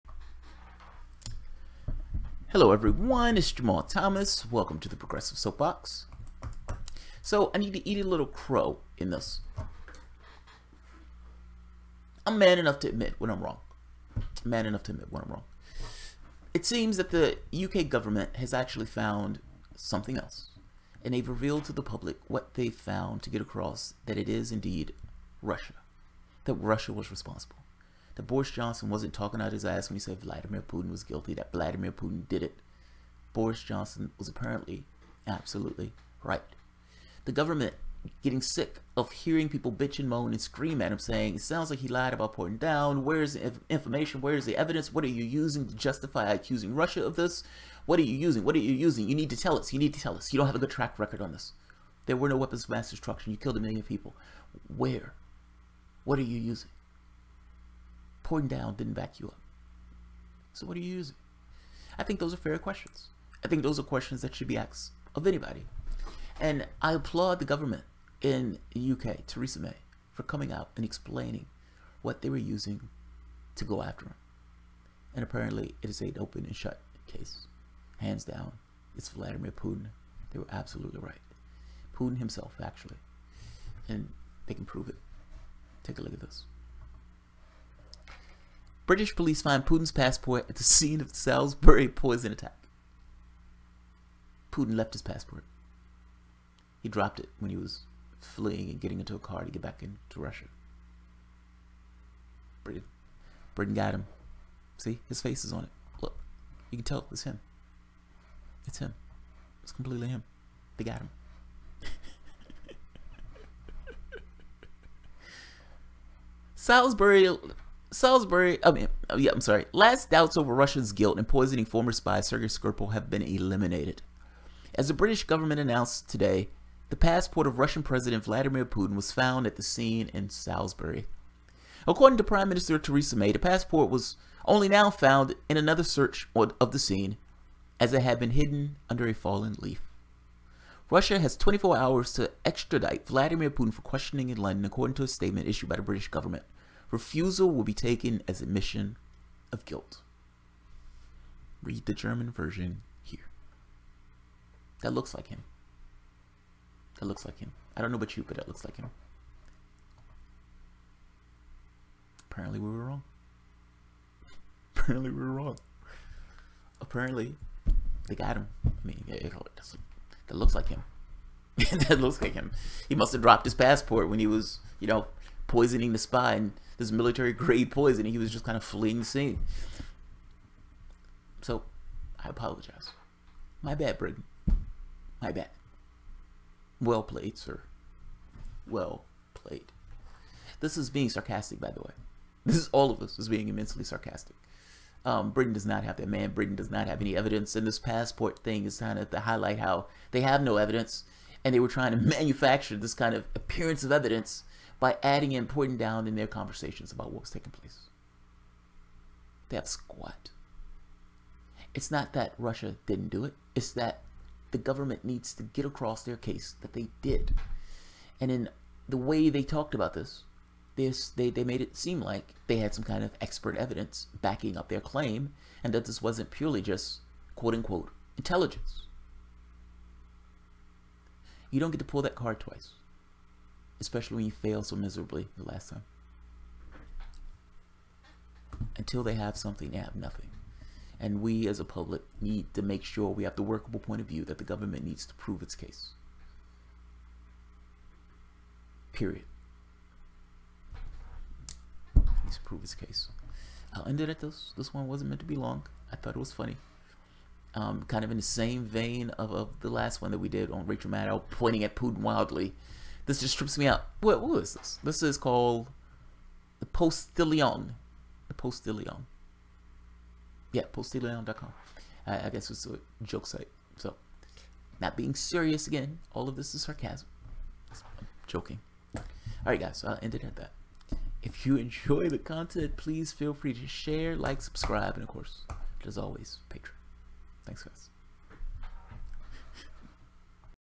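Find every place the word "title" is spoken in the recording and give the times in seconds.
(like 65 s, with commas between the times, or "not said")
not said.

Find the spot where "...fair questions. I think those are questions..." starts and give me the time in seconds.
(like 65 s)
62 s.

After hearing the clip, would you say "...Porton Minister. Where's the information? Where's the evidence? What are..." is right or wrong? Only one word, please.
wrong.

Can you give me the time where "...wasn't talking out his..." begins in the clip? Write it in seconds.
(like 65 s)
28 s.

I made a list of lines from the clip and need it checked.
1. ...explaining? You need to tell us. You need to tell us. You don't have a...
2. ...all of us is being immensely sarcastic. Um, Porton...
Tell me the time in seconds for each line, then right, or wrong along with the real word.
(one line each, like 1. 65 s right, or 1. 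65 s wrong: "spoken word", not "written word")
1. 48 s wrong: "using", not "explaining"
2. 192 s wrong: "Britain", not "Porton".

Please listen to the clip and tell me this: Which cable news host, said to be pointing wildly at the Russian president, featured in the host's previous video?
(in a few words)
Rachel Maddow.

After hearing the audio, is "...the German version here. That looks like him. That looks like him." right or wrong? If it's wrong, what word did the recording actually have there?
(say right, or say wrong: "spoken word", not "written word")
right.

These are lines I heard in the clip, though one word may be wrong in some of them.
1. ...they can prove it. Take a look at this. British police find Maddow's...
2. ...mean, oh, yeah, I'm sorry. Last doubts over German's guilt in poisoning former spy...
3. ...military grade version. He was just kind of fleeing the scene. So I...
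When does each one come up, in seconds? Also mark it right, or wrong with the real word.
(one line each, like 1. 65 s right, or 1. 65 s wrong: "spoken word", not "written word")
1. 84 s wrong: "Putin", not "Maddow"
2. 118 s wrong: "Russia", not "German"
3. 176 s wrong: "poison", not "version".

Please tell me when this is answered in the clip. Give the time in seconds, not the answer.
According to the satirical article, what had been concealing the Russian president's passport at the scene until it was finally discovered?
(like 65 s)
139 s.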